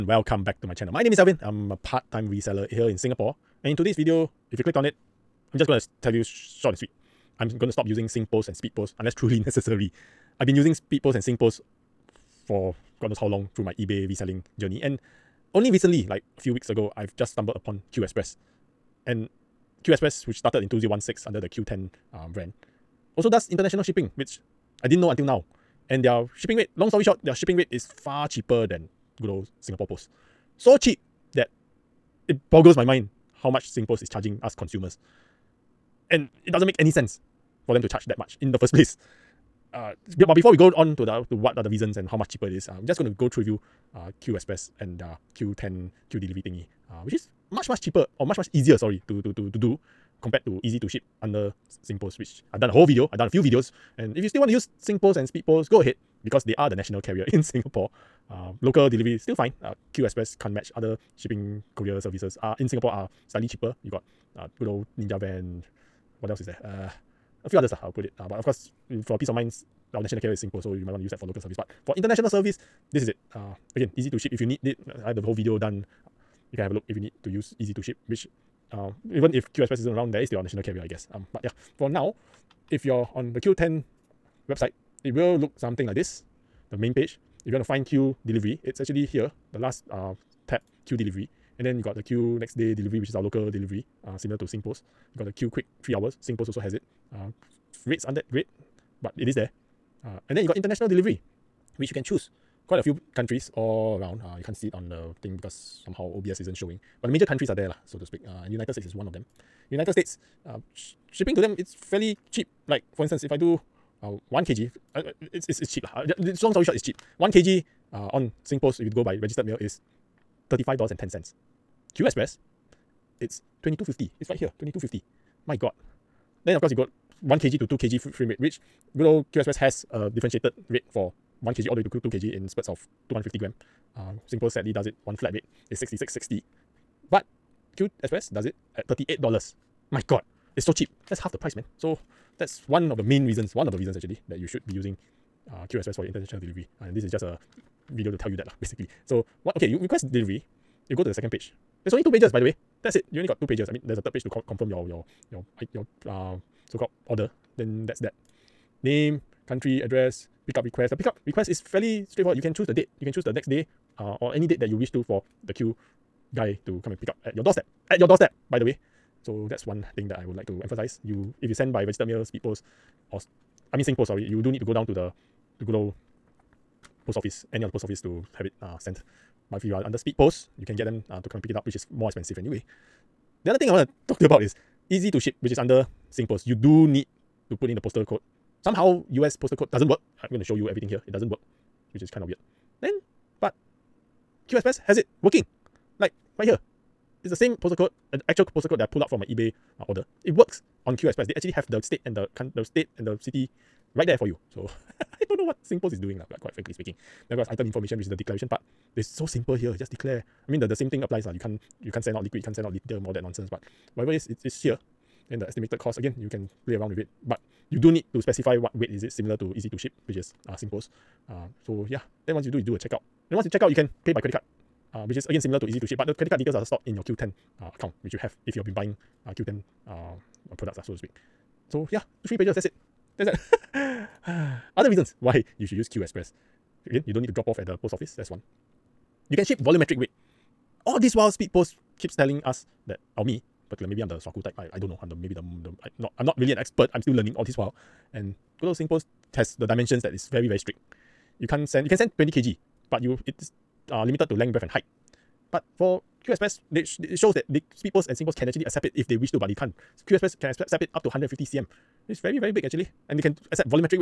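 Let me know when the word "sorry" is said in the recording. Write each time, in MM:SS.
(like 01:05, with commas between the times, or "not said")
00:48, 02:54.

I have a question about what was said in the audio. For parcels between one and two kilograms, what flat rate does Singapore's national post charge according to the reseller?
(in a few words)
66.60.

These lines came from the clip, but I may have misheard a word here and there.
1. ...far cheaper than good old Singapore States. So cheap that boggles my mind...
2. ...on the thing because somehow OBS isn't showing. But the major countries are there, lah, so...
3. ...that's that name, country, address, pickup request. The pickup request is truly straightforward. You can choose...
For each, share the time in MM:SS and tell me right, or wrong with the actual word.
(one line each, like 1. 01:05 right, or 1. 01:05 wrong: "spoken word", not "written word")
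1. 00:27 wrong: "Post", not "States"
2. 01:44 right
3. 02:37 wrong: "fairly", not "truly".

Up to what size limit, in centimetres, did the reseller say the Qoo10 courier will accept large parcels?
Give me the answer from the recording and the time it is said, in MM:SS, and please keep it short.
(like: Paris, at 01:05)
150 cm, at 04:21.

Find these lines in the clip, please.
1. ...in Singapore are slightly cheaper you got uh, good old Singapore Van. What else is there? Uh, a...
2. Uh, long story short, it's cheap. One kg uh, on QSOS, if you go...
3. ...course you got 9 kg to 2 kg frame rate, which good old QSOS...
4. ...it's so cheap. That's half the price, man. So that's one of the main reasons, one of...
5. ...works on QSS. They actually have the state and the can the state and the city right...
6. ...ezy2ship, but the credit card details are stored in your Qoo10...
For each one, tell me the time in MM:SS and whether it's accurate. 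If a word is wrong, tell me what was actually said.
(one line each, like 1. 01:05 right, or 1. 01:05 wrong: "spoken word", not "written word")
1. 01:02 wrong: "Ninja", not "Singapore"
2. 01:55 wrong: "Singpost", not "QSOS"
3. 02:06 wrong: "1", not "9"
4. 02:20 right
5. 03:20 right
6. 03:45 right.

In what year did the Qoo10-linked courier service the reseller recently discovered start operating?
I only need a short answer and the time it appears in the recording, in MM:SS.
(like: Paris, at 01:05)
2016, at 00:20.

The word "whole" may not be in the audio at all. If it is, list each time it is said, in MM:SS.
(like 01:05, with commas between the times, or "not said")
00:52, 01:15.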